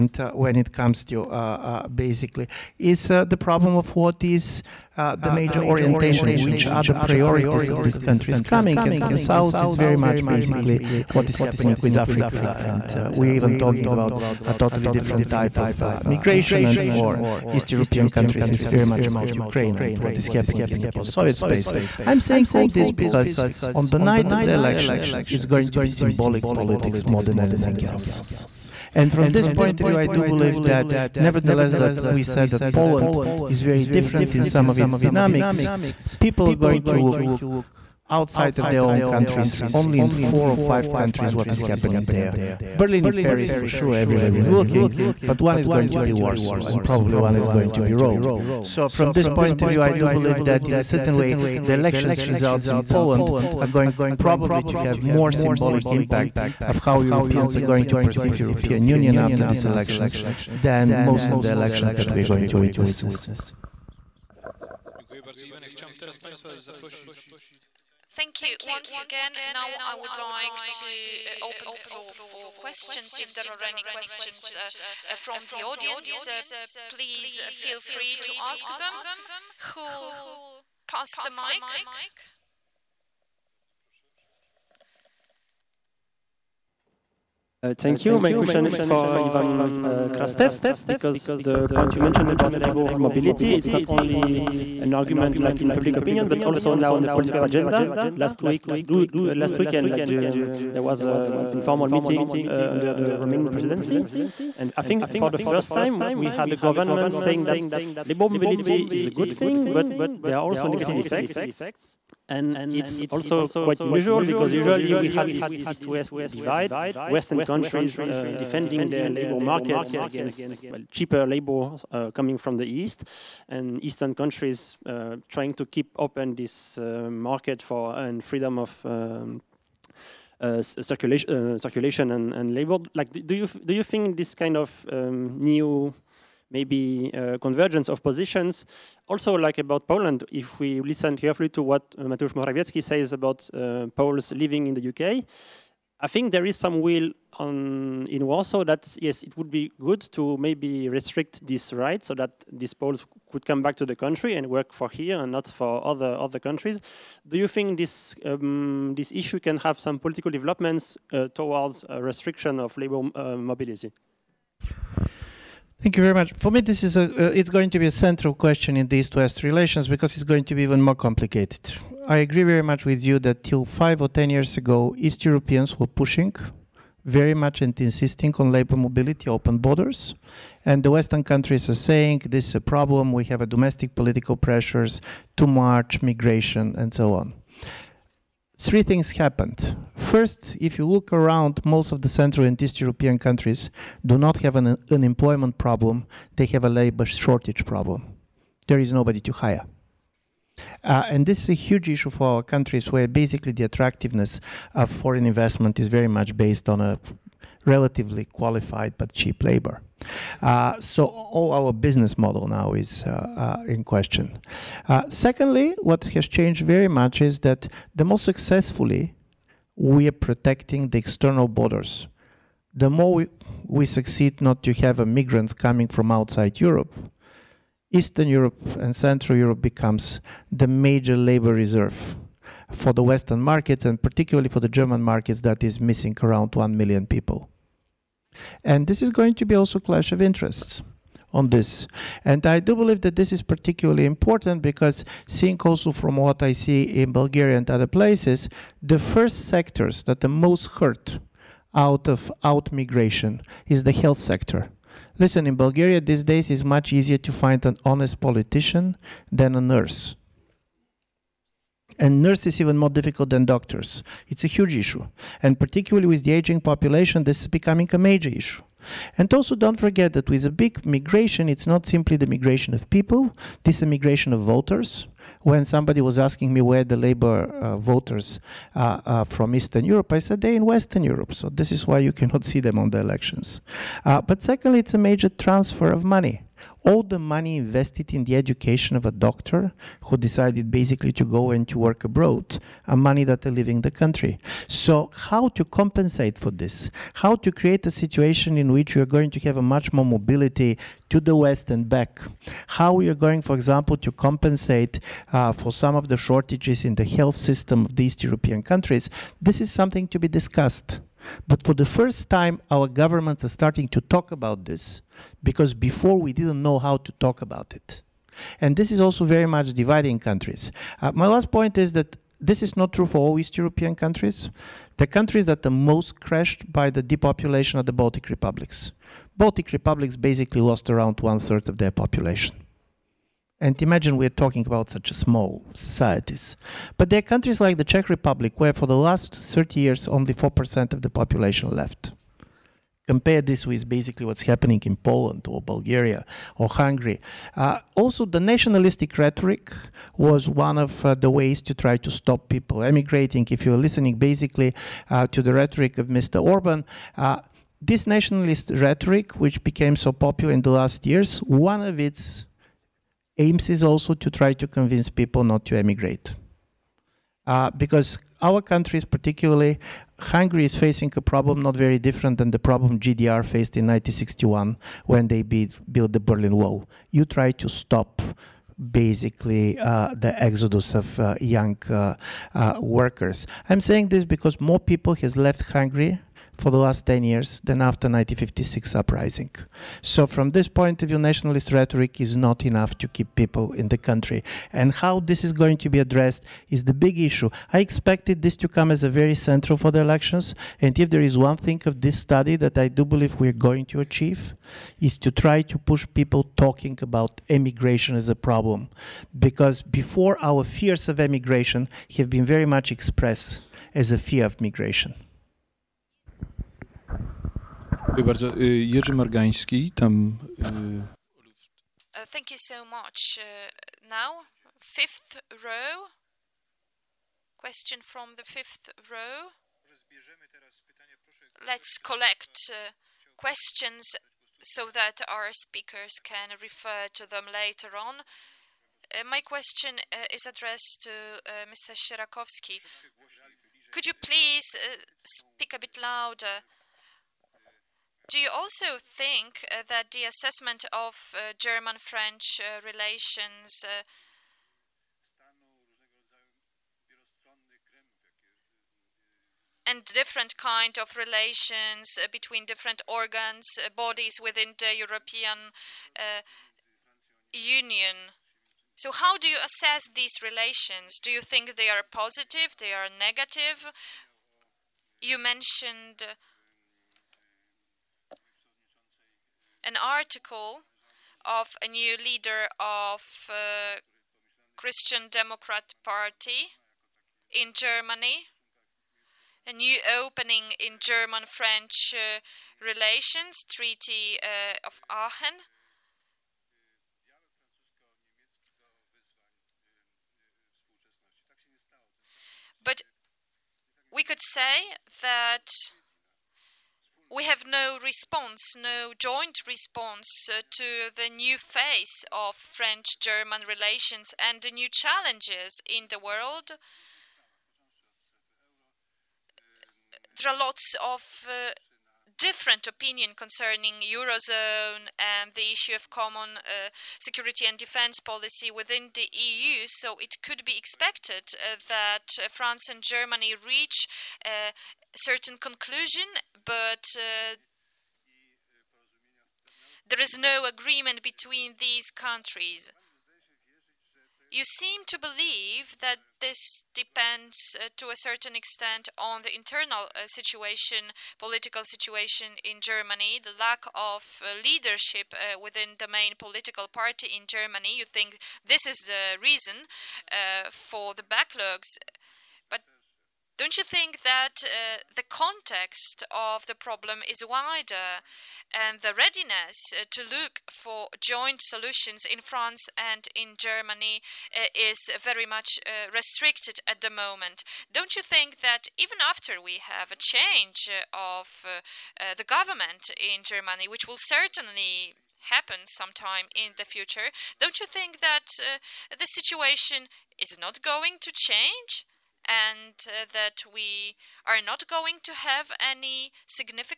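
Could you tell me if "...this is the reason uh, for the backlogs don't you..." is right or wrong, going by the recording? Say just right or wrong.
right.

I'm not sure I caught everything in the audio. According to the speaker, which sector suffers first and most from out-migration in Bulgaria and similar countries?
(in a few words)
health sector.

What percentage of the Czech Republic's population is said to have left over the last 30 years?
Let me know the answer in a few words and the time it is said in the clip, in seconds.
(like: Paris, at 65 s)
4%, at 340 s.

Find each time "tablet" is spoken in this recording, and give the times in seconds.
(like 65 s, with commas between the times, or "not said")
not said.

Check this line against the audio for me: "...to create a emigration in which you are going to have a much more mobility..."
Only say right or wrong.
wrong.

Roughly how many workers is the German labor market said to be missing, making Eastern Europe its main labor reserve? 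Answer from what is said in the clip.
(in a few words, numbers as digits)
1 million.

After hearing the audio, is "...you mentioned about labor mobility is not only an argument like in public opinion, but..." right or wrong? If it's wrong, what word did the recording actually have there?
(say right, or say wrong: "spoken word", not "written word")
right.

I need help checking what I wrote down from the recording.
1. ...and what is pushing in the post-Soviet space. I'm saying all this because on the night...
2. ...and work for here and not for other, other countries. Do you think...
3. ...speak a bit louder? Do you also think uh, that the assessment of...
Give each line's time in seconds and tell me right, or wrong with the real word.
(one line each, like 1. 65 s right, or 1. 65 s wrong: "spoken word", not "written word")
1. 19 s wrong: "happening", not "pushing"
2. 154 s right
3. 445 s right.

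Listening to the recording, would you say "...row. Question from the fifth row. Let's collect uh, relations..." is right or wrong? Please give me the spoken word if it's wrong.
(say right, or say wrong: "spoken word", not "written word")
wrong: "questions", not "relations".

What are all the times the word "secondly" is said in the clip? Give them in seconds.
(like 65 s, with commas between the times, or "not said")
215 s, 284 s.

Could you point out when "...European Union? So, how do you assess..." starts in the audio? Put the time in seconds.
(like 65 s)
464 s.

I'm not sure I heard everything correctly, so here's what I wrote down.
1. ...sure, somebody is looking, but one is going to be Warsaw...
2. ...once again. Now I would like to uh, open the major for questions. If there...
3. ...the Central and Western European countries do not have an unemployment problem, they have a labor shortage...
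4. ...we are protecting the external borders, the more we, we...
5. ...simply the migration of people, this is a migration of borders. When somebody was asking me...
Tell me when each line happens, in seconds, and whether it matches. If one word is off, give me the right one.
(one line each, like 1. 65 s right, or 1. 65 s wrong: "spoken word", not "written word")
1. 43 s wrong: "everybody", not "somebody"
2. 68 s wrong: "floor", not "major"
3. 192 s wrong: "East", not "Western"
4. 219 s right
5. 271 s wrong: "voters", not "borders".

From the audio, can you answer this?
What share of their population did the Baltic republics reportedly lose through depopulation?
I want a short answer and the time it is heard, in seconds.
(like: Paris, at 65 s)
one third, at 331 s.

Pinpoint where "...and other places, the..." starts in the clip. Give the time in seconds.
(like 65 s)
247 s.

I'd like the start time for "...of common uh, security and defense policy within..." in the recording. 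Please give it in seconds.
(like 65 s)
525 s.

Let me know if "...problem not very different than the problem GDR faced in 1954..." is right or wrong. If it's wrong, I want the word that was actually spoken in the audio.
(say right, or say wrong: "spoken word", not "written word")
wrong: "1961", not "1954".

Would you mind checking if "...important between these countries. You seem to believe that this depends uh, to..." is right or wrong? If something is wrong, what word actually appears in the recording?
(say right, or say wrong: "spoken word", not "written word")
wrong: "agreement", not "important".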